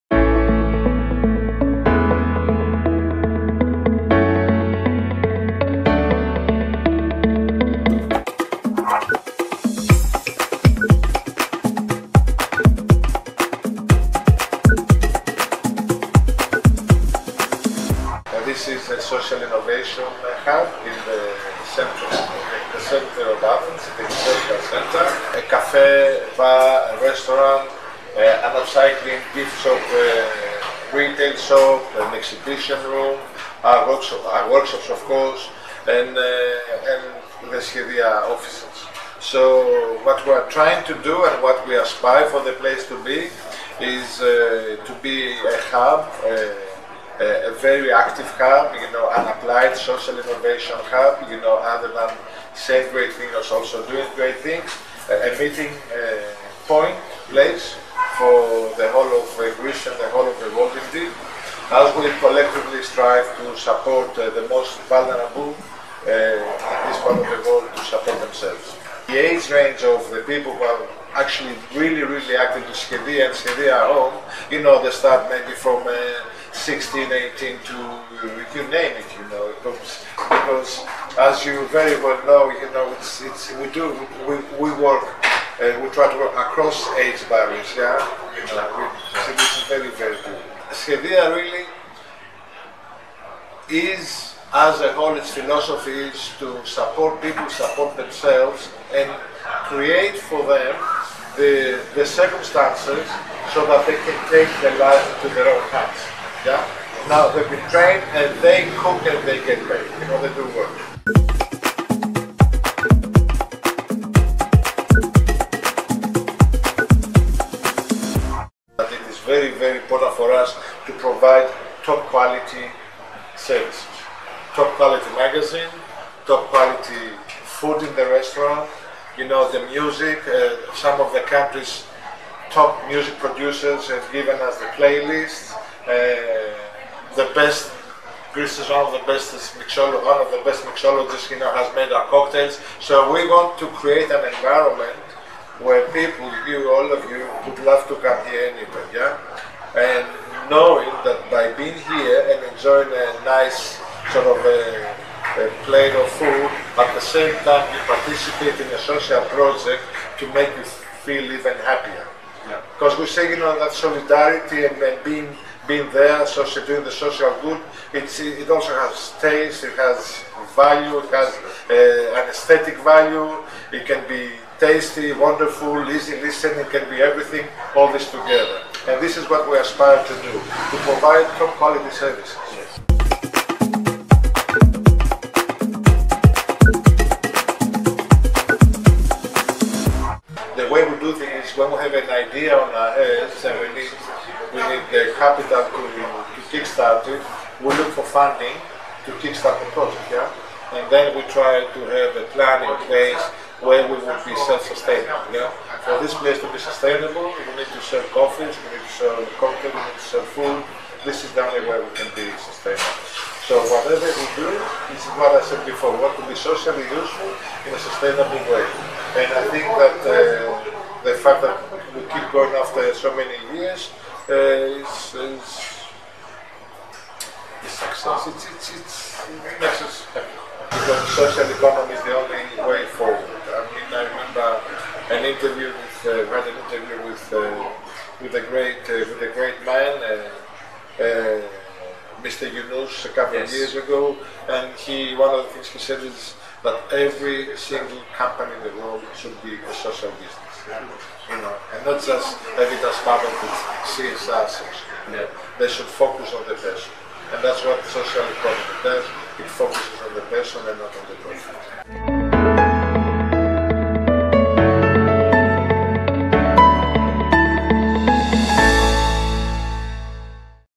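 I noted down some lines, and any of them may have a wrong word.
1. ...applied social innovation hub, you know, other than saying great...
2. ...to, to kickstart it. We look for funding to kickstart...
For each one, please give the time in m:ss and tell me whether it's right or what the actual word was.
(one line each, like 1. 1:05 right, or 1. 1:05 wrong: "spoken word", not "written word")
1. 0:49 right
2. 3:15 right.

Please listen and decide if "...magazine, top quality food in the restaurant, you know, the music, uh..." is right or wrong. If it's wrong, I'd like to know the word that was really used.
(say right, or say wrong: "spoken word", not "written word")
right.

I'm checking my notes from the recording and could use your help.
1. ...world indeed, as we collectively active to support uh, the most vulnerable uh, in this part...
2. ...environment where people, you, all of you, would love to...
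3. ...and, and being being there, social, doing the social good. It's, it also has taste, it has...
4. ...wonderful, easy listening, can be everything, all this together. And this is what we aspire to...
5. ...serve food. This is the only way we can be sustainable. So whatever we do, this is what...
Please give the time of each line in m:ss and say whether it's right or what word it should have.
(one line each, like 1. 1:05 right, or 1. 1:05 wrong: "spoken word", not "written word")
1. 1:00 wrong: "strive", not "active"
2. 2:24 right
3. 2:44 right
4. 2:55 right
5. 3:30 right.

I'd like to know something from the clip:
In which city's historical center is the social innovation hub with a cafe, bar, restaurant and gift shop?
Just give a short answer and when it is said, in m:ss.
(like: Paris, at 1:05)
Athens, at 0:23.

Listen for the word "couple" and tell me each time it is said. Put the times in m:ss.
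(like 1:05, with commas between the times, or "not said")
4:03.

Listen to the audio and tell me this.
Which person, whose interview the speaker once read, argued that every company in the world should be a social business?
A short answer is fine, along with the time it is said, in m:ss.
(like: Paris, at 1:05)
Mr. Yunus, at 4:02.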